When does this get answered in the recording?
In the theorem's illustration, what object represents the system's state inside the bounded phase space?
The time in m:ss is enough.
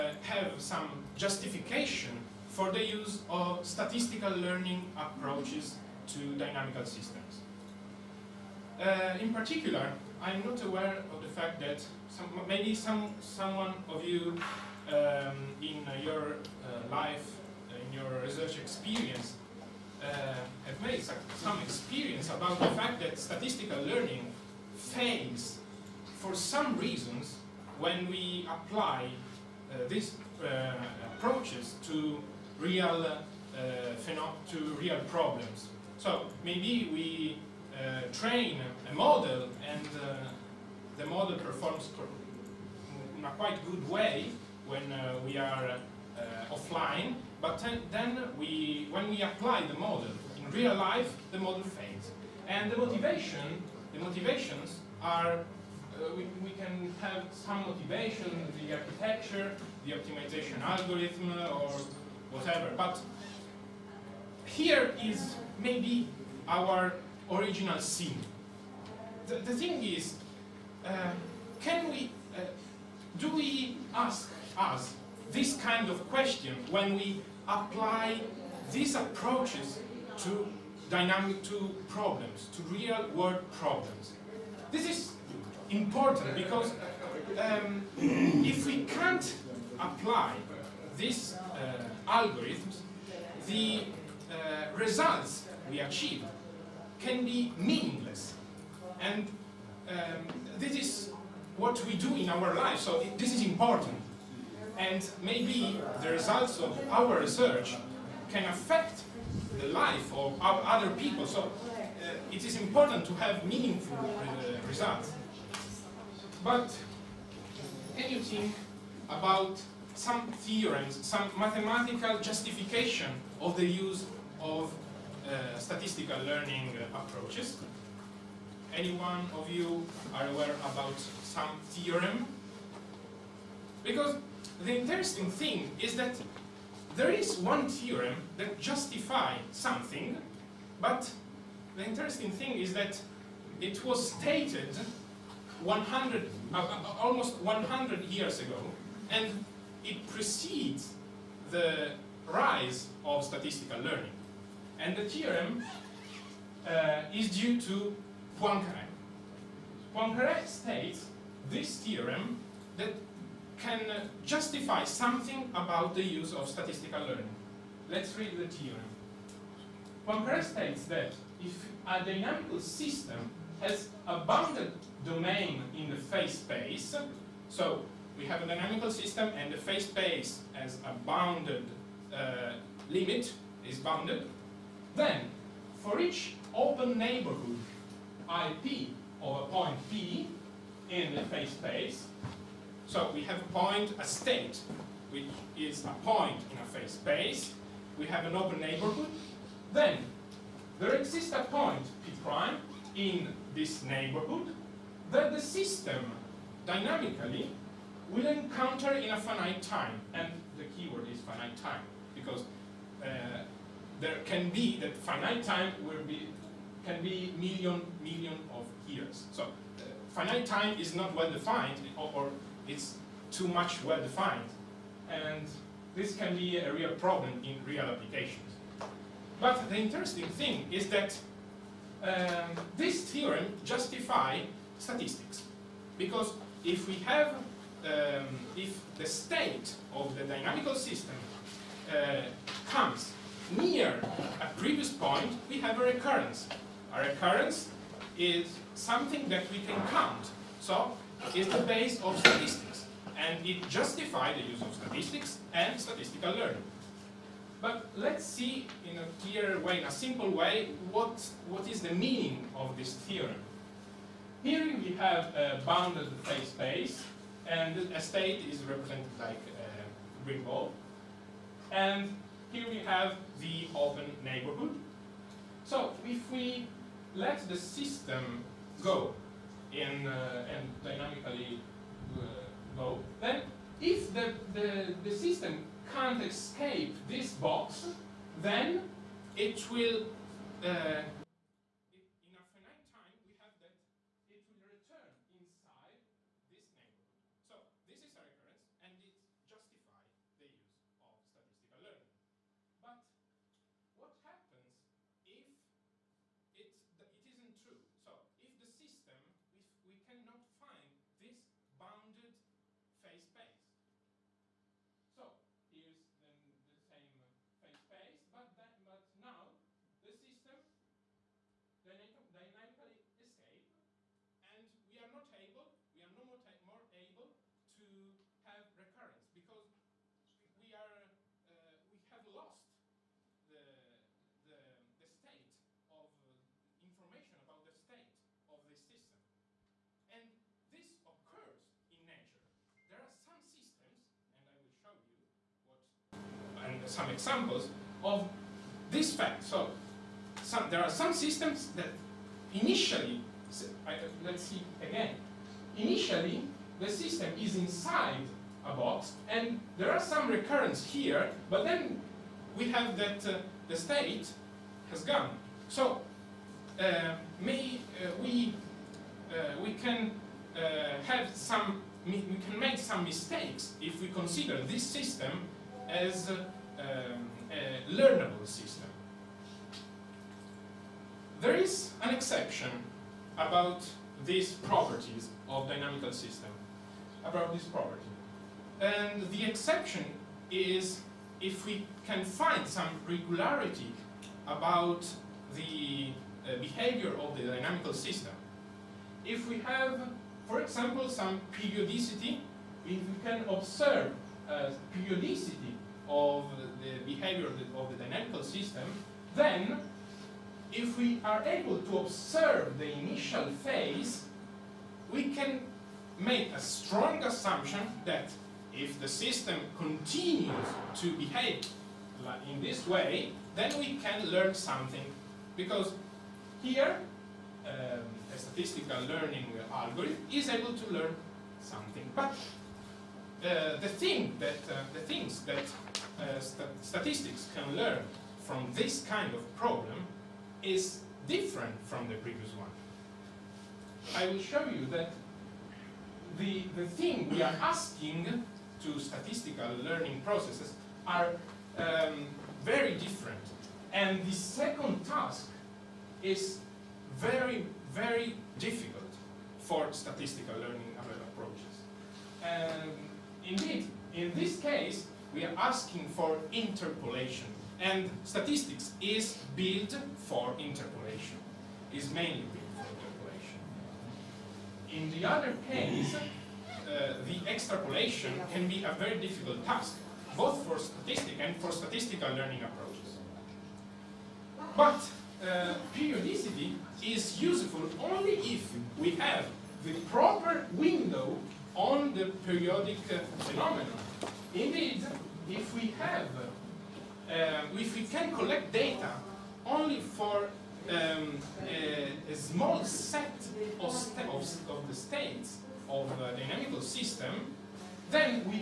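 4:30.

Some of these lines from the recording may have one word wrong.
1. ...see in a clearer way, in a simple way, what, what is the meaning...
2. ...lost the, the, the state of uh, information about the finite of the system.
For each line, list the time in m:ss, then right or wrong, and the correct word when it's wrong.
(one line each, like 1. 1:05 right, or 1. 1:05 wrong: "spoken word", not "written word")
1. 4:18 right
2. 5:32 wrong: "state", not "finite".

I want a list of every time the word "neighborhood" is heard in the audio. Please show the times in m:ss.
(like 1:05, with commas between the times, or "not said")
3:06, 3:18, 3:23, 4:34, 4:56.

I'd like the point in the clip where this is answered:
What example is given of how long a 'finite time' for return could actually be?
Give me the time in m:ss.
3:37.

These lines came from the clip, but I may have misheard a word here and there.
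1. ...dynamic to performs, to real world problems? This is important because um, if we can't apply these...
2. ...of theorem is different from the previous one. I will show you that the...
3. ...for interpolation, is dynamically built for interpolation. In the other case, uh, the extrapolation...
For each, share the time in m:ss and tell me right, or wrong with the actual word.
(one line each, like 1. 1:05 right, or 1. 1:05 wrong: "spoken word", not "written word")
1. 1:20 wrong: "problems", not "performs"
2. 7:19 wrong: "problem", not "theorem"
3. 7:50 wrong: "mainly", not "dynamically".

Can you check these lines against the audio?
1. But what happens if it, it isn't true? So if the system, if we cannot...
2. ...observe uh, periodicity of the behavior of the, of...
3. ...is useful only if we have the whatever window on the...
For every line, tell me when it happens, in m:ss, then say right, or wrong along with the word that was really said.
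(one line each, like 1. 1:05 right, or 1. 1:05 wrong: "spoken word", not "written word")
1. 5:02 right
2. 6:43 right
3. 8:07 wrong: "proper", not "whatever".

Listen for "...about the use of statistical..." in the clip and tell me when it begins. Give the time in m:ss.
2:45.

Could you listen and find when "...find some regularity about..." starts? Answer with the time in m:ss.
6:32.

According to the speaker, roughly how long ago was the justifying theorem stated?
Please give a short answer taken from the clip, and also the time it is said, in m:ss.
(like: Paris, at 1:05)
almost 100 years, at 2:26.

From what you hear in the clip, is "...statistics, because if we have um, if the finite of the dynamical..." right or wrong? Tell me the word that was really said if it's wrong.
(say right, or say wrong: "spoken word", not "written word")
wrong: "state", not "finite".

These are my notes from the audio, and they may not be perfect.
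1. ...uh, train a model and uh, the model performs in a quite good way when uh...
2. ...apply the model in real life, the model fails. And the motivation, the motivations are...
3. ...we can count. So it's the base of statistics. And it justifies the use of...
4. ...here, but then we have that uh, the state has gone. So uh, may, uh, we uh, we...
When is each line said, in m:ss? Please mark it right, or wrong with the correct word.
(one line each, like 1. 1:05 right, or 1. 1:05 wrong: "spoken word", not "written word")
1. 0:37 right
2. 0:49 right
3. 4:09 right
4. 6:00 right.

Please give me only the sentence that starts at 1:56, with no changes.
But can you think about some theorems, some mathematical justification of the use of uh, statistical learning approaches.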